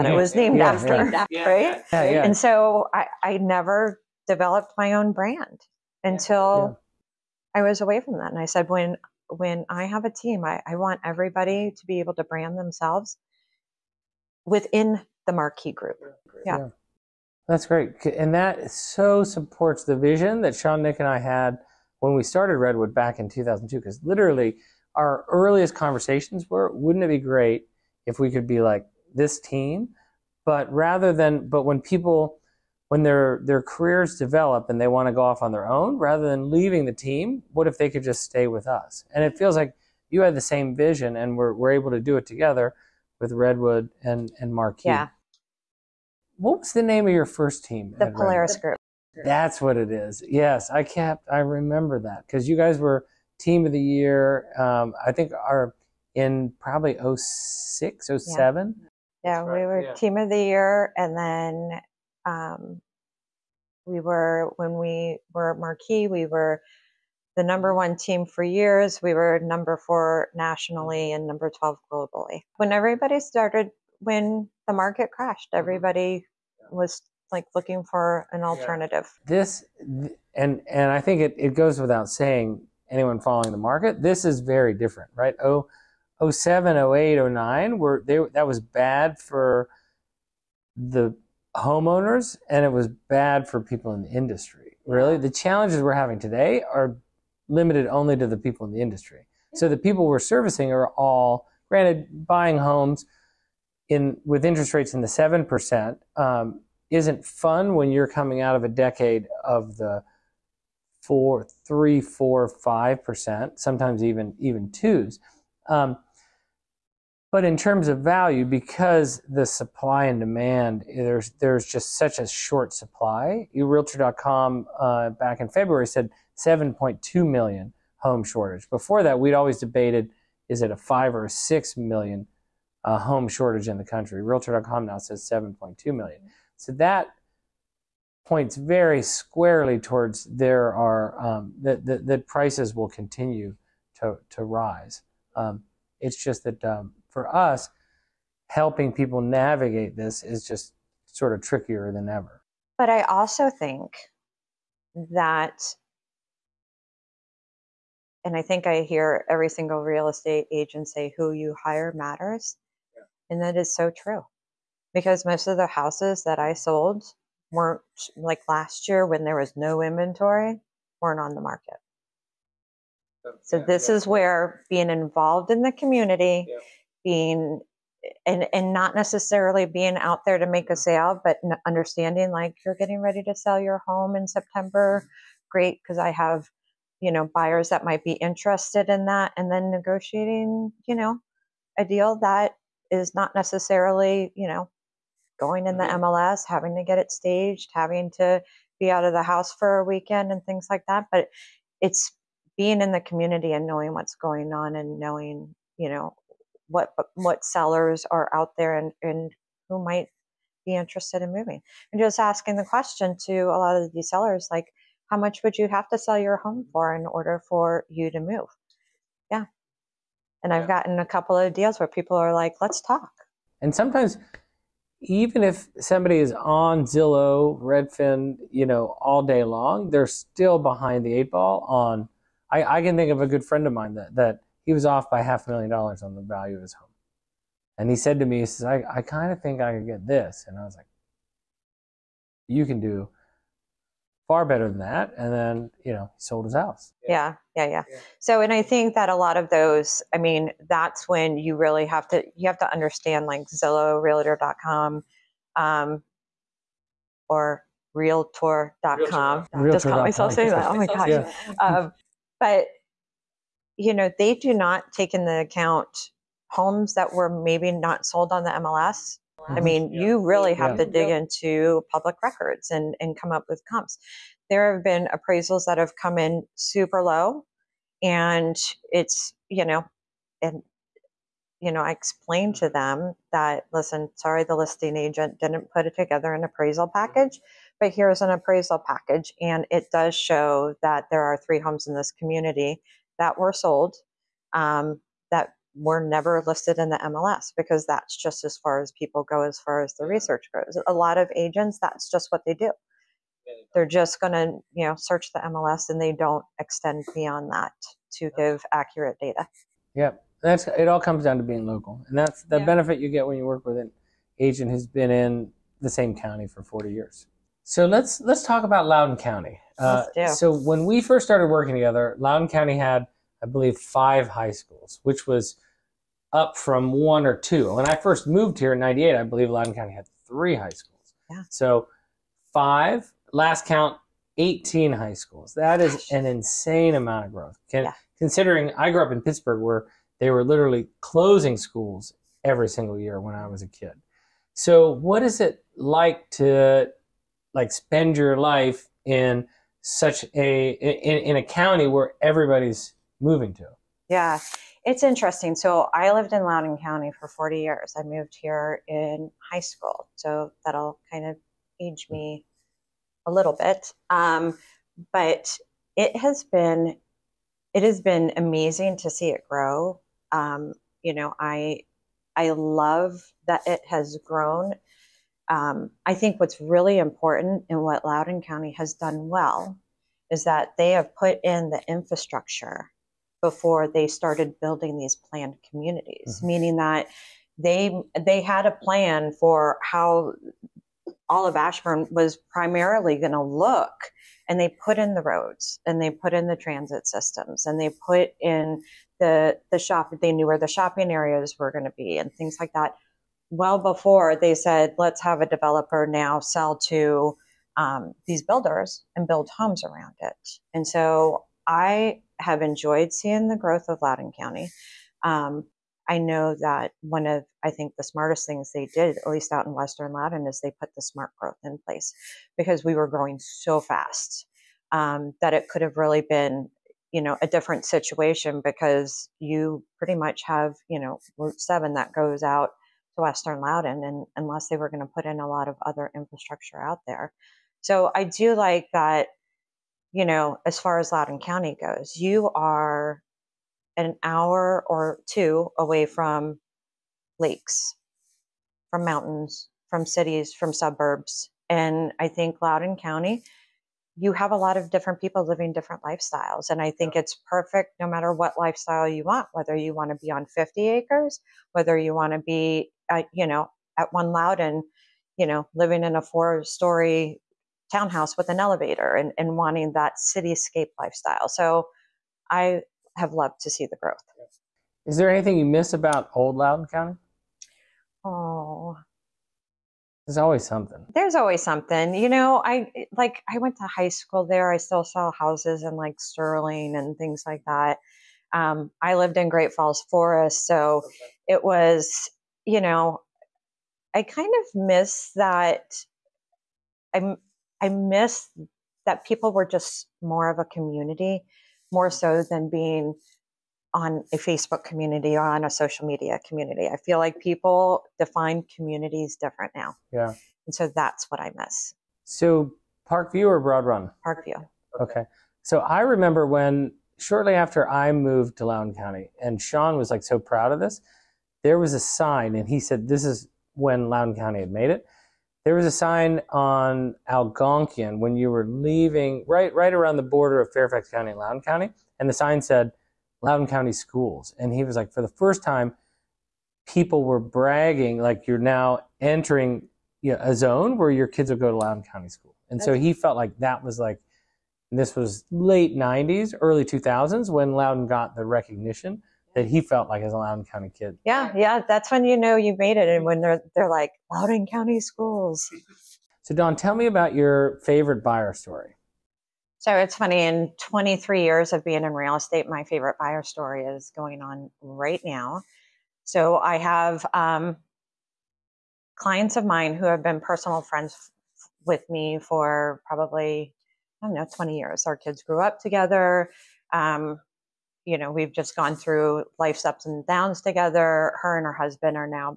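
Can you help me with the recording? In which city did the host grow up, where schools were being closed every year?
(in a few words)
Pittsburgh.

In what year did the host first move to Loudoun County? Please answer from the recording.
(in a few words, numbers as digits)
1998.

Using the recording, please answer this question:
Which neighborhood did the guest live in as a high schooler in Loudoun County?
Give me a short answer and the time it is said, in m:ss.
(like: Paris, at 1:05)
Great Falls Forest, at 8:09.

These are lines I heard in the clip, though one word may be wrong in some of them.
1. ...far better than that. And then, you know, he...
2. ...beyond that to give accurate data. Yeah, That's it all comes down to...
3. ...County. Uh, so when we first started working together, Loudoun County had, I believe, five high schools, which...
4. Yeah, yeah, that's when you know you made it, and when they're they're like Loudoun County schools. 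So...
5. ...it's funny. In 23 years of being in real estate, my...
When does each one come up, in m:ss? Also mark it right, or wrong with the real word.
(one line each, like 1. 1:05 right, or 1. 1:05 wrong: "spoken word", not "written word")
1. 4:04 right
2. 5:07 right
3. 5:19 right
4. 9:11 right
5. 9:19 right.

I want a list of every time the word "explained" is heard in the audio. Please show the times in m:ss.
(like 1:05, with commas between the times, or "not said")
4:41.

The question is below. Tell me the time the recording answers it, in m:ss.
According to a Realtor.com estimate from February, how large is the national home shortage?
2:06.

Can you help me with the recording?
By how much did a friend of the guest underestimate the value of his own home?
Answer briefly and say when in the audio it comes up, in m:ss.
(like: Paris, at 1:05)
Half a million dollars, at 3:55.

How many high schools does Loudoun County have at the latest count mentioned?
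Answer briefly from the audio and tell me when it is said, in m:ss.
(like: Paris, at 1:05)
18, at 5:34.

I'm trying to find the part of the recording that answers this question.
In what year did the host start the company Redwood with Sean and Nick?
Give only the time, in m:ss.
0:23.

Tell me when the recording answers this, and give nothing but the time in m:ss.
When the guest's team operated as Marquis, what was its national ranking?
1:09.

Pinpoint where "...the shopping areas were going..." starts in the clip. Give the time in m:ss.
6:40.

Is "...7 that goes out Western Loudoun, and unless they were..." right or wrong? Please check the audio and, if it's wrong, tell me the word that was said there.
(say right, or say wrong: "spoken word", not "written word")
right.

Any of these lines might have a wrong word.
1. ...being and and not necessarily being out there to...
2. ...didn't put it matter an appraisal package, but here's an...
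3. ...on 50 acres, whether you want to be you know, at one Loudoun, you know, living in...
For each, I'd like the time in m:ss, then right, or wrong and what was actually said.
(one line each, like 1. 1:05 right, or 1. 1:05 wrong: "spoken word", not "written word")
1. 2:57 right
2. 4:45 wrong: "together", not "matter"
3. 7:40 right.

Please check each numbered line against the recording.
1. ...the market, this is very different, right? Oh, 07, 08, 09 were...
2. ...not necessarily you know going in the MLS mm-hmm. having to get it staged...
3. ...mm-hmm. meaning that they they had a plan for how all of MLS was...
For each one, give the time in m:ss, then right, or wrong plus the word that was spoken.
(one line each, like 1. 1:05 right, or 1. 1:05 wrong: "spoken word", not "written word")
1. 1:23 right
2. 3:13 right
3. 6:26 wrong: "Ashburn", not "MLS".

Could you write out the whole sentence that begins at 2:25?
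Um, it's just that um, for us, helping people navigate this is just sort of trickier than ever.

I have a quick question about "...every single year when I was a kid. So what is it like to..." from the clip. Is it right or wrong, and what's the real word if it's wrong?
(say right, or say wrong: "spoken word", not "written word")
right.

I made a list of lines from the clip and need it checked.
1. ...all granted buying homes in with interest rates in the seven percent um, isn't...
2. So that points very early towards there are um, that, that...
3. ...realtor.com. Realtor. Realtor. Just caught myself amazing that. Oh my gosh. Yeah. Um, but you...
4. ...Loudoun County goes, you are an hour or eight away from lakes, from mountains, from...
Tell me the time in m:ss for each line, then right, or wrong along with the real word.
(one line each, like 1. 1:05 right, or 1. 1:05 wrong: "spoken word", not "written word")
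1. 1:40 right
2. 2:16 wrong: "squarely", not "early"
3. 4:17 wrong: "saying", not "amazing"
4. 7:21 wrong: "two", not "eight".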